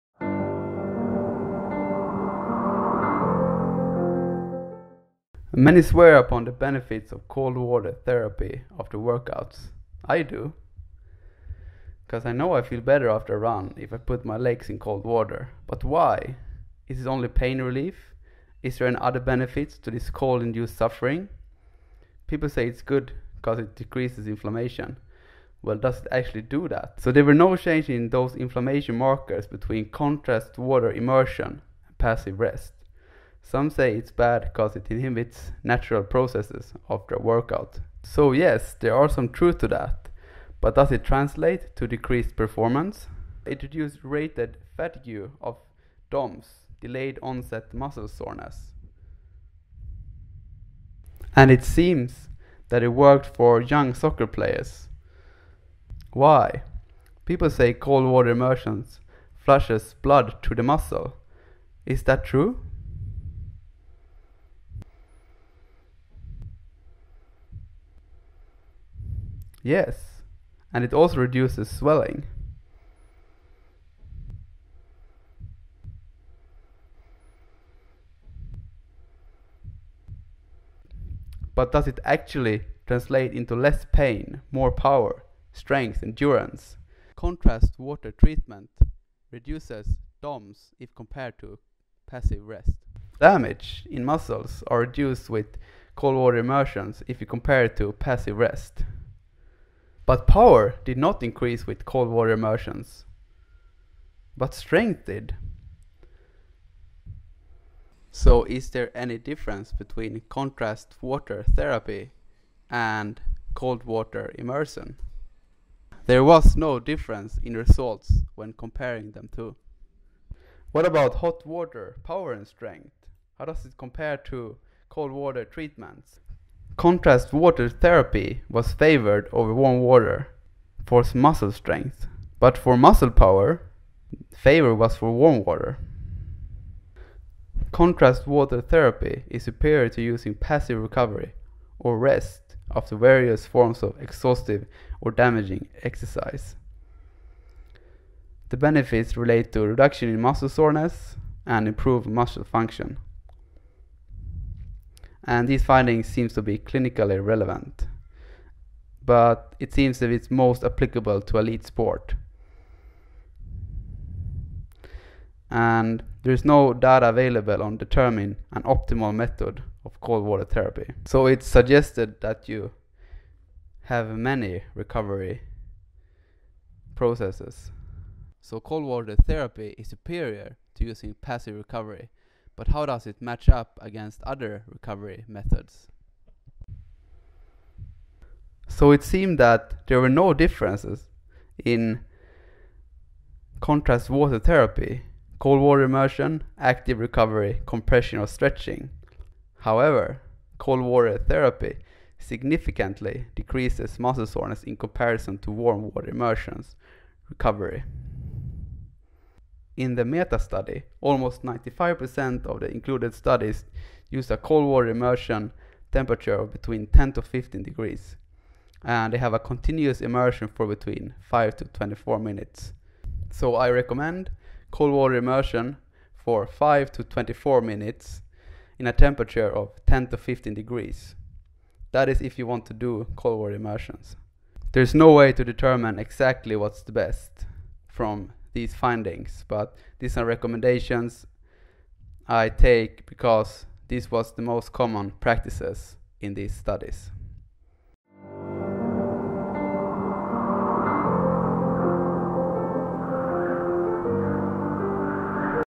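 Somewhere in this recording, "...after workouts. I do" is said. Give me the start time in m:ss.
0:08.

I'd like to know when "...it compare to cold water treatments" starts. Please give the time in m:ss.
2:03.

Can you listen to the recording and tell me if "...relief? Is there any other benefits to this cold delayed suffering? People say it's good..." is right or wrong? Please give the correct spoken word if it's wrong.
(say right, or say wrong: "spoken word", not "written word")
wrong: "induced", not "delayed".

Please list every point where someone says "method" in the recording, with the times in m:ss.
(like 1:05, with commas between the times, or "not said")
2:49, 3:05.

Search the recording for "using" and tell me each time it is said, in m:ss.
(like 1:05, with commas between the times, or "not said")
2:20, 3:00.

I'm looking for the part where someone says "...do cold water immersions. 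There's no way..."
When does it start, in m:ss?
3:52.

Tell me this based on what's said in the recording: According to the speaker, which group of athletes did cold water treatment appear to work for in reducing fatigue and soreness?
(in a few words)
young soccer players.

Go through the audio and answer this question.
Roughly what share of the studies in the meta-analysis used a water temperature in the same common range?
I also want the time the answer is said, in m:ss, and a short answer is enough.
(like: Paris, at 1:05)
almost 95%, at 3:31.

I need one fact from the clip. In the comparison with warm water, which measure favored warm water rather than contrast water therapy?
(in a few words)
muscle power.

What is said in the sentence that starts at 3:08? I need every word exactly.
So it seemed that there were no differences in contrast water therapy, cold water immersion, active recovery, compression or stretching.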